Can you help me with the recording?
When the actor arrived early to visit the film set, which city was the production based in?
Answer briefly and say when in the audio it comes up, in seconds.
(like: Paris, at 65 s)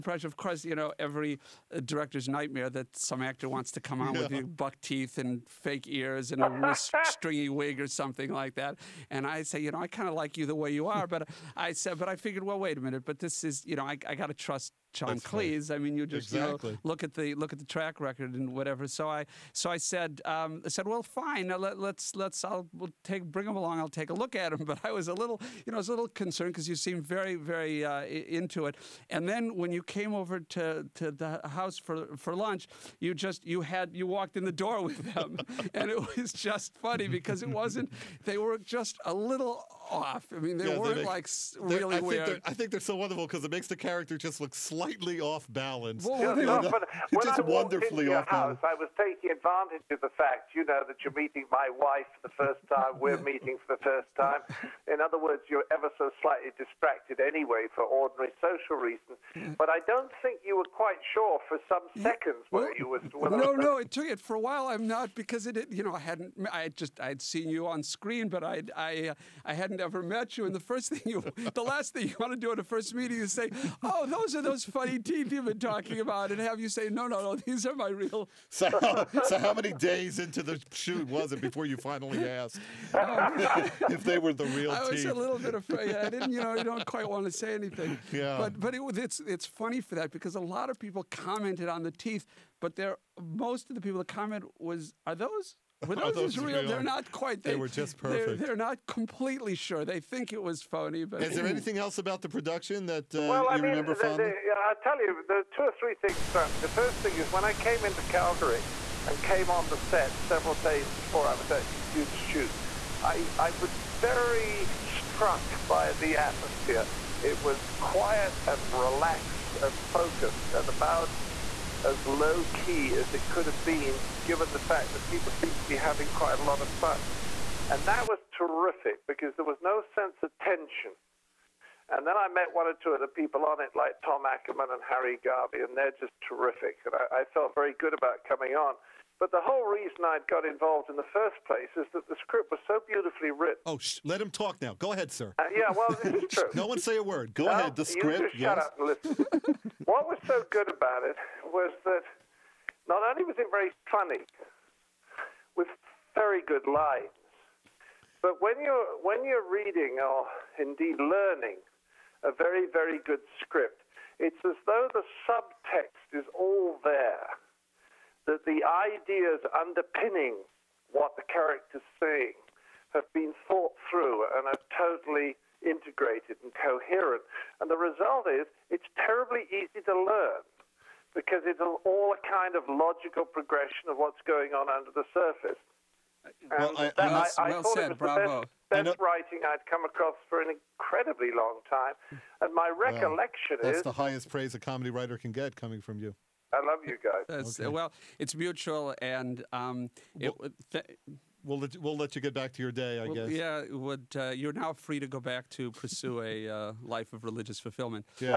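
Calgary, at 108 s.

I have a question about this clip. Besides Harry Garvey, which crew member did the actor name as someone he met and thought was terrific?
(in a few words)
Tom Ackerman.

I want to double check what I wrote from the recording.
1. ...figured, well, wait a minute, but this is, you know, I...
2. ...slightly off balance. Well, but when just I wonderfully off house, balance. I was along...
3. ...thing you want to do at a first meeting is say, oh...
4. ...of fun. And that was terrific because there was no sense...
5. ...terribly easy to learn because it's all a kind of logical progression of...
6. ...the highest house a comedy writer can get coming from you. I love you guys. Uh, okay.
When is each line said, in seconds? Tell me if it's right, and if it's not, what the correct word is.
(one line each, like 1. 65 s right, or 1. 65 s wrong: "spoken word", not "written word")
1. 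12 s right
2. 44 s wrong: "taking", not "along"
3. 71 s right
4. 126 s right
5. 178 s right
6. 193 s wrong: "praise", not "house".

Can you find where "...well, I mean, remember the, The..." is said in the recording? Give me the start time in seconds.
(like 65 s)
103 s.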